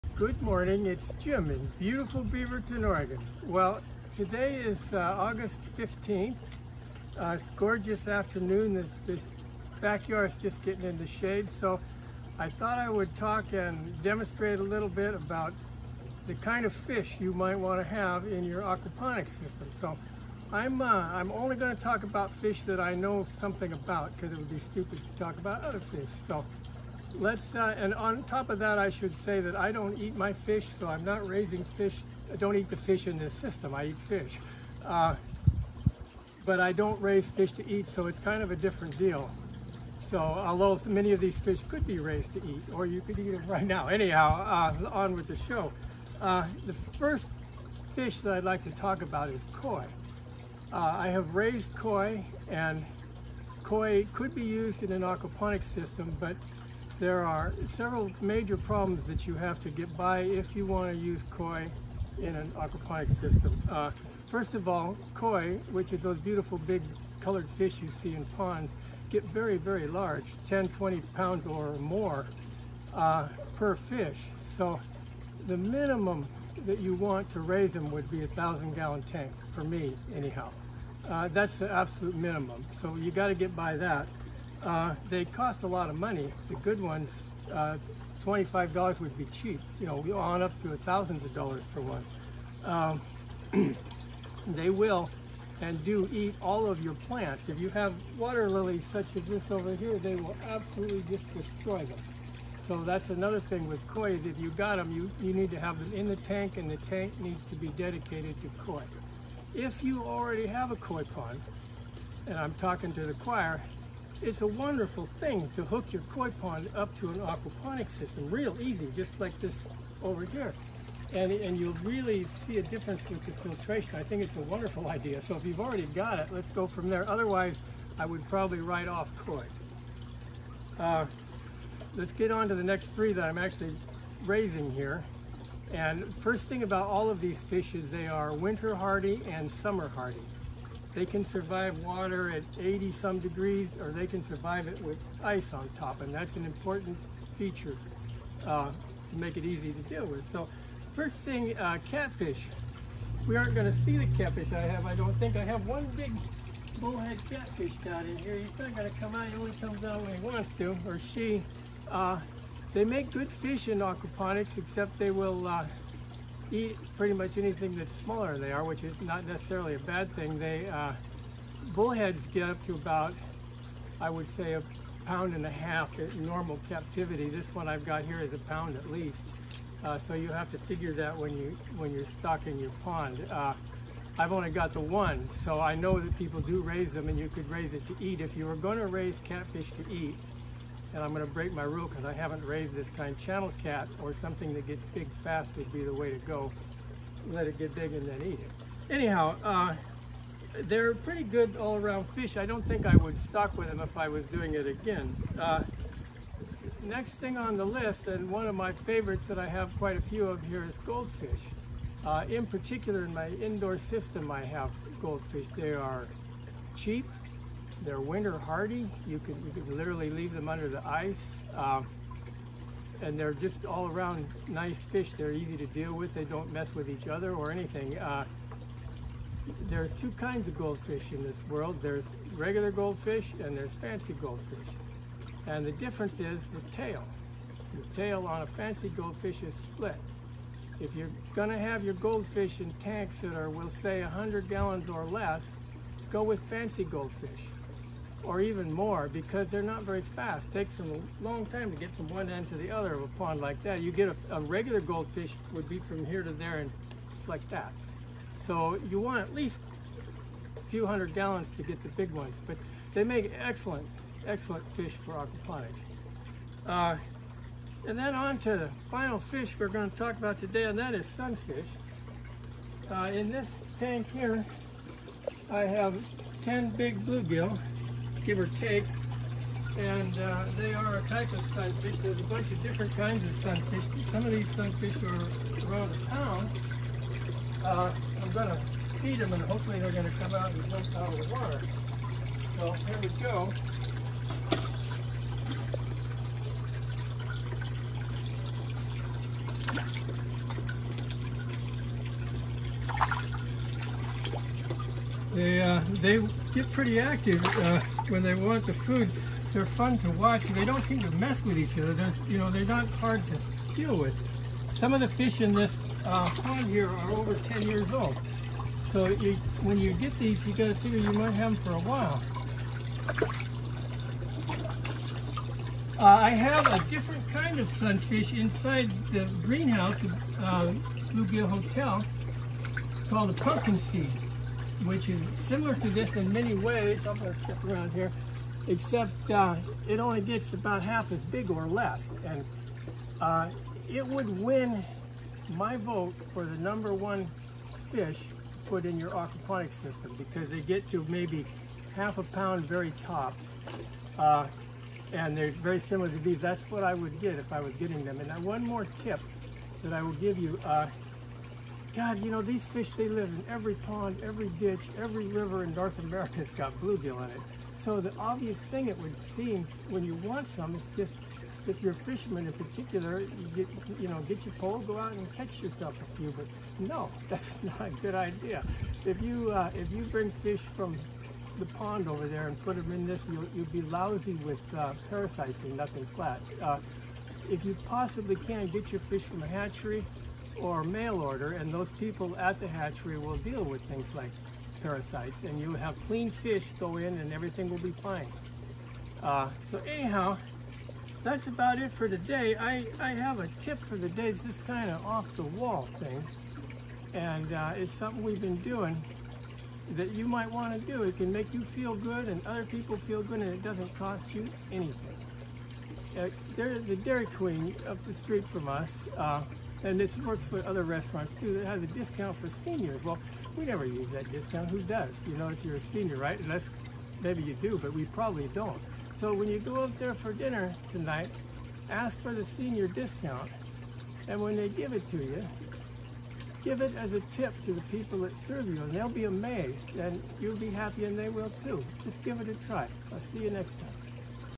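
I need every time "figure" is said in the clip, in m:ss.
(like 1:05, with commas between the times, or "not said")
3:00, 5:20.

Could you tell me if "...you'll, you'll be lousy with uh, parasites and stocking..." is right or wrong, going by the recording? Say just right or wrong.
wrong.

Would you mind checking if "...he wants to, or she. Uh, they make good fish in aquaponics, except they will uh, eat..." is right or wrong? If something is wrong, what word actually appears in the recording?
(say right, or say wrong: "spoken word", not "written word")
right.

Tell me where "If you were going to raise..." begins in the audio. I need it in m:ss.
3:08.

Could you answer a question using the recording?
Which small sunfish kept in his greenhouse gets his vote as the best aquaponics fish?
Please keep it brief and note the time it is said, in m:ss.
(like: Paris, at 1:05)
Pumpkin seed, at 5:33.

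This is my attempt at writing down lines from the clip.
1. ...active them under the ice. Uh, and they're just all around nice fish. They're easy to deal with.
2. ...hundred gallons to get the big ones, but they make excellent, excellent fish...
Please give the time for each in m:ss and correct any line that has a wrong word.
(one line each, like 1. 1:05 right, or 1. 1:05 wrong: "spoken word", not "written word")
1. 3:40 wrong: "leave", not "active"
2. 4:20 right.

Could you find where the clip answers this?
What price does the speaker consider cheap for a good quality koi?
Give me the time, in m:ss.
1:28.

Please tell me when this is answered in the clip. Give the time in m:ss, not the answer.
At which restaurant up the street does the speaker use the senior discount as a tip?
6:56.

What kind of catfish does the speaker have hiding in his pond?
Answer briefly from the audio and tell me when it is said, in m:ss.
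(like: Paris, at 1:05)
Bullhead, at 2:36.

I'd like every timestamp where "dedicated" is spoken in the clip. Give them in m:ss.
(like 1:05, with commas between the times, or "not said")
1:47.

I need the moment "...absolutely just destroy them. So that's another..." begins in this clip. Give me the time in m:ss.
1:40.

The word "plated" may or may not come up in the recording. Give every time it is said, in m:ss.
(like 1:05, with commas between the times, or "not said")
not said.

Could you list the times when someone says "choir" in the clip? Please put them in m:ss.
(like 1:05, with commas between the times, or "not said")
1:53.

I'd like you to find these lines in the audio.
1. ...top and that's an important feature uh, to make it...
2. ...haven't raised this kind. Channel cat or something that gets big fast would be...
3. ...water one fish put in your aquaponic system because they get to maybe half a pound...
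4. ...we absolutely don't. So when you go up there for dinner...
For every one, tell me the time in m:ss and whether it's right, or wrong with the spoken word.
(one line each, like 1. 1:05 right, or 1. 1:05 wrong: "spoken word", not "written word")
1. 2:25 right
2. 3:12 right
3. 5:46 wrong: "number", not "water"
4. 7:07 wrong: "probably", not "absolutely".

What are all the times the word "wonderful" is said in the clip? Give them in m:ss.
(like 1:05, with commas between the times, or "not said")
1:54, 2:04.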